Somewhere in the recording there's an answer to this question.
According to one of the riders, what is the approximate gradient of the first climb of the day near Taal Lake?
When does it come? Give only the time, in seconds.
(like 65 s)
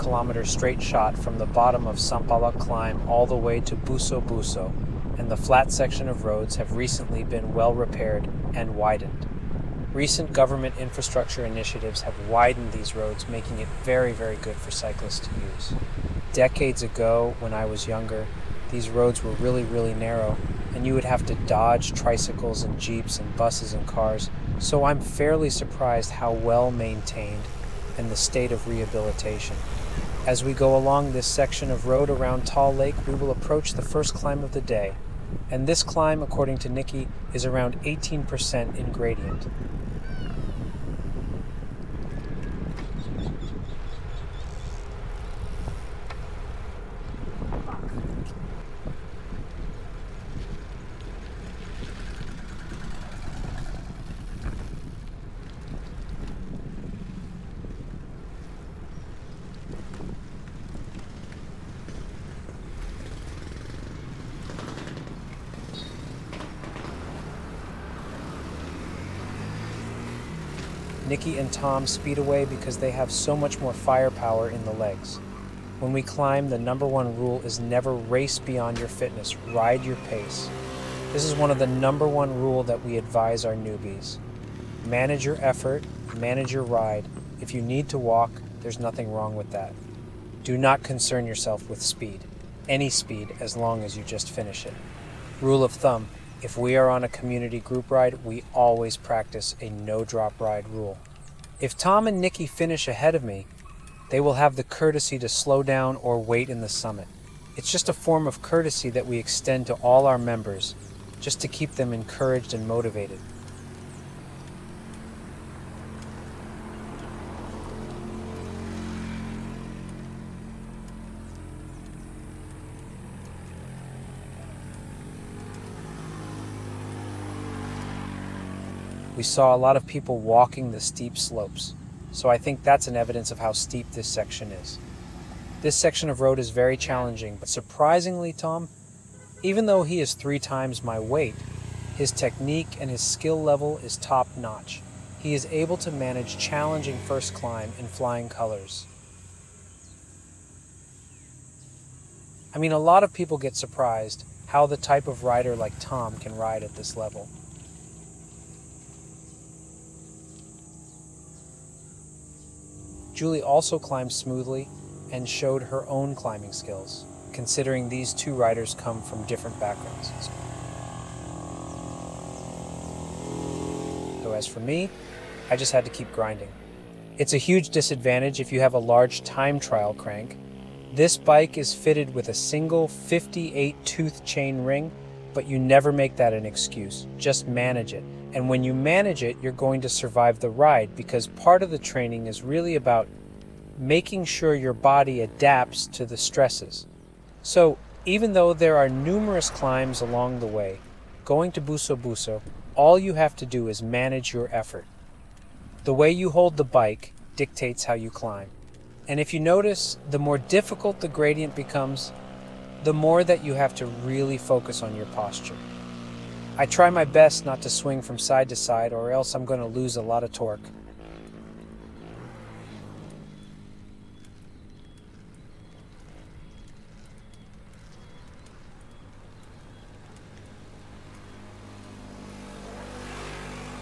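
37 s.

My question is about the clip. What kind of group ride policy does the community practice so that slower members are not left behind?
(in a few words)
no drop ride.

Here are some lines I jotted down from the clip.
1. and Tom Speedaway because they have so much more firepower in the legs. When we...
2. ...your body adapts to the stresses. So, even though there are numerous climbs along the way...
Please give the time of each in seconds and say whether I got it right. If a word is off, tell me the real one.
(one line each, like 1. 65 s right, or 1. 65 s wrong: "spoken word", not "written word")
1. 71 s right
2. 194 s right.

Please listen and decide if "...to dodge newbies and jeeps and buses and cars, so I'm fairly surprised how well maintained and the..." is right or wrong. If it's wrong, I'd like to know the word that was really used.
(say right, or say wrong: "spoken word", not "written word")
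wrong: "tricycles", not "newbies".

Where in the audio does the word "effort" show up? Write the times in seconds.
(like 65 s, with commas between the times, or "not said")
85 s, 204 s.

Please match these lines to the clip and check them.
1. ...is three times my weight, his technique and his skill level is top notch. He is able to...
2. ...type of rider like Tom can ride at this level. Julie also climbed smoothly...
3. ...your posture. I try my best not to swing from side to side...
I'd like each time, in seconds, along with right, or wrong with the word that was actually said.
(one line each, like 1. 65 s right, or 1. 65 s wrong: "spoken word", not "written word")
1. 140 s right
2. 154 s right
3. 214 s right.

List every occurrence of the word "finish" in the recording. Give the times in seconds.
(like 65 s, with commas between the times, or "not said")
94 s, 102 s.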